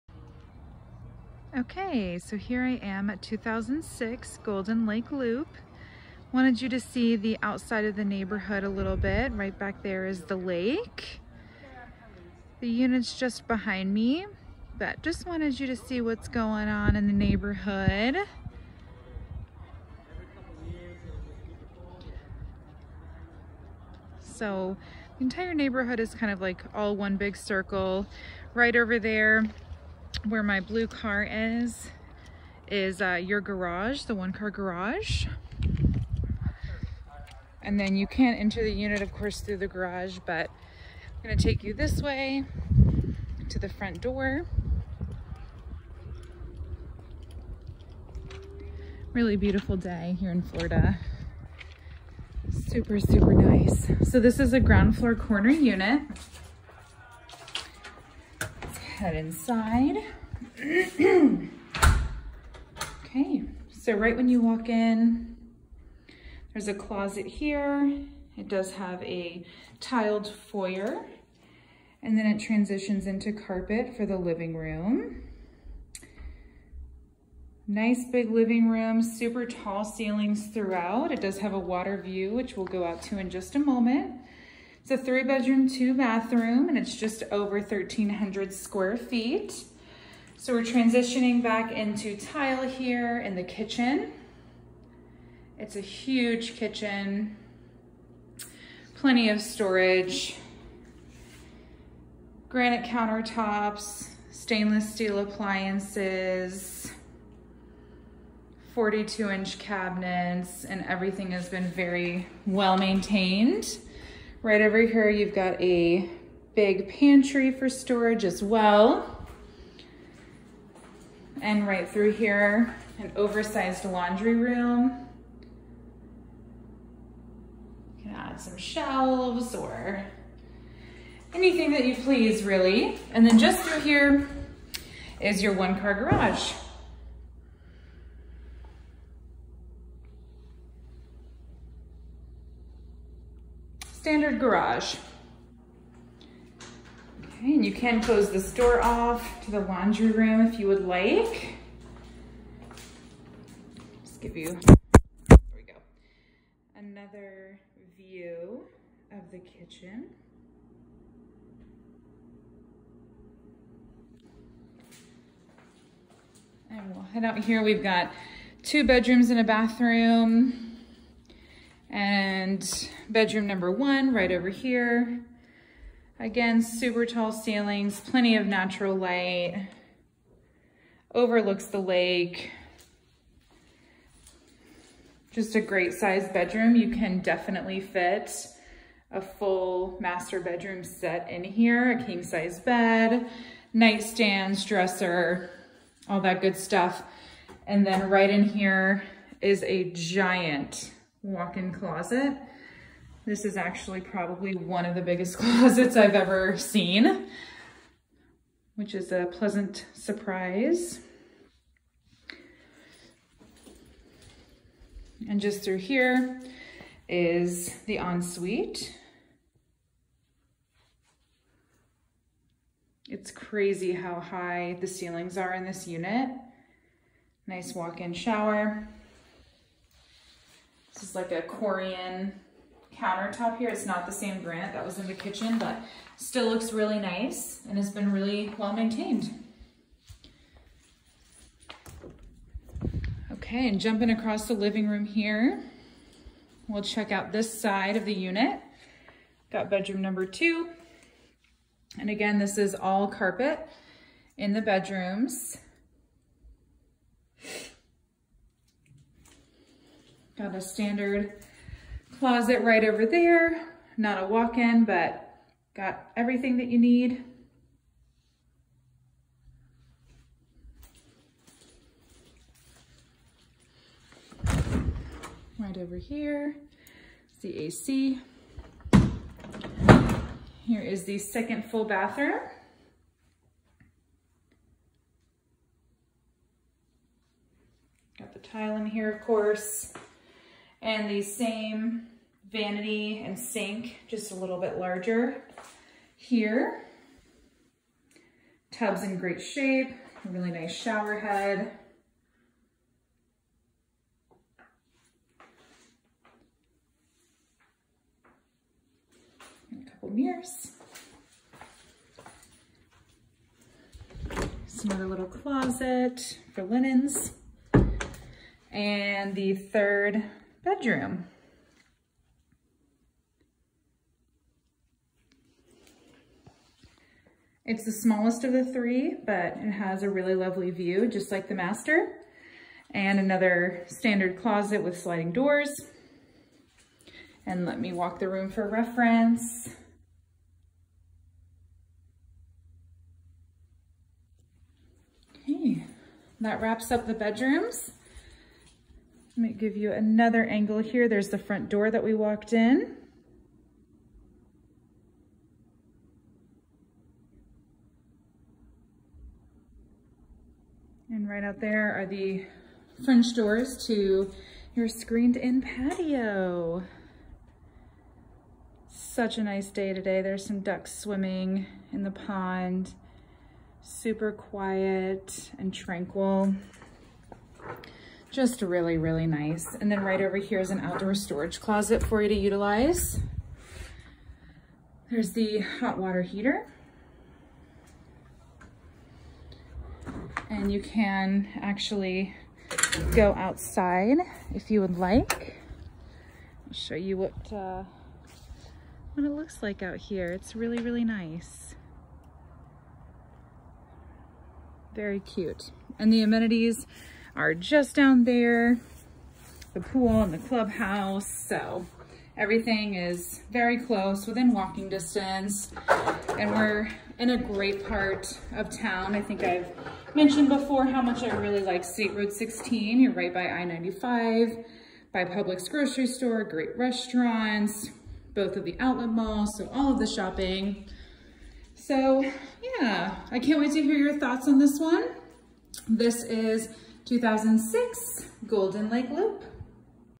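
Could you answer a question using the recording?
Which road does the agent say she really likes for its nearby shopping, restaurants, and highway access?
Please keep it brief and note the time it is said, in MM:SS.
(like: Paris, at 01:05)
State Road 16, at 07:01.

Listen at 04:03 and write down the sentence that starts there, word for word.
Okay, and jumping across the living room here, we'll check out this side of the unit.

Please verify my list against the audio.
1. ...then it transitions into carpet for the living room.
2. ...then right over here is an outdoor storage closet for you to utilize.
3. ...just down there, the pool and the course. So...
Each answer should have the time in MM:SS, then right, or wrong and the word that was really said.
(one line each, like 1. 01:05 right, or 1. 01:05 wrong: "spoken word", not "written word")
1. 01:12 right
2. 06:19 right
3. 06:47 wrong: "clubhouse", not "course".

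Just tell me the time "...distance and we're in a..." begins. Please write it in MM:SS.
06:54.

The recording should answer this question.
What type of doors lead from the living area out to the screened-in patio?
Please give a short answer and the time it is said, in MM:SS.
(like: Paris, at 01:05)
French doors, at 06:03.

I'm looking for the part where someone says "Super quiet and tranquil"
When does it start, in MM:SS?
06:13.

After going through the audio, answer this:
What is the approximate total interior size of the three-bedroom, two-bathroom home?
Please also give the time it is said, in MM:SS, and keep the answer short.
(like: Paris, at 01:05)
just over 1,300 square feet, at 01:26.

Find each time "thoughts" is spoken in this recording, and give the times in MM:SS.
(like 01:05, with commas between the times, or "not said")
07:14.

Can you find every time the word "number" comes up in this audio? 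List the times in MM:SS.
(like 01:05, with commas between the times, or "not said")
02:53, 04:10.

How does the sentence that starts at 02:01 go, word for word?
And right through here, an oversized laundry room.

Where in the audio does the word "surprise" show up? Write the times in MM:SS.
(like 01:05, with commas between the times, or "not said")
03:29.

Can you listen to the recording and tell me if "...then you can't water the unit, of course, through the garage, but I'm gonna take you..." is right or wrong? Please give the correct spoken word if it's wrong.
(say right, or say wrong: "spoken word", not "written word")
wrong: "enter", not "water".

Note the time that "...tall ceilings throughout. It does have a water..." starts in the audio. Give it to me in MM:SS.
01:19.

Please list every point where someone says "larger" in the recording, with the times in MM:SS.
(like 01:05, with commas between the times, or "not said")
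04:54.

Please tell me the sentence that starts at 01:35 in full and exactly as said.
It's a huge kitchen, plenty of storage, granite countertops, stainless steel appliances, 42 inch cabinets, and everything has been very well maintained.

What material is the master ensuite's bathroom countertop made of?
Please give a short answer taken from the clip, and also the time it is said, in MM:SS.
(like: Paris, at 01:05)
Corian, at 03:51.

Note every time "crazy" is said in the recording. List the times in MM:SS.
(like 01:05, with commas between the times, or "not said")
03:43.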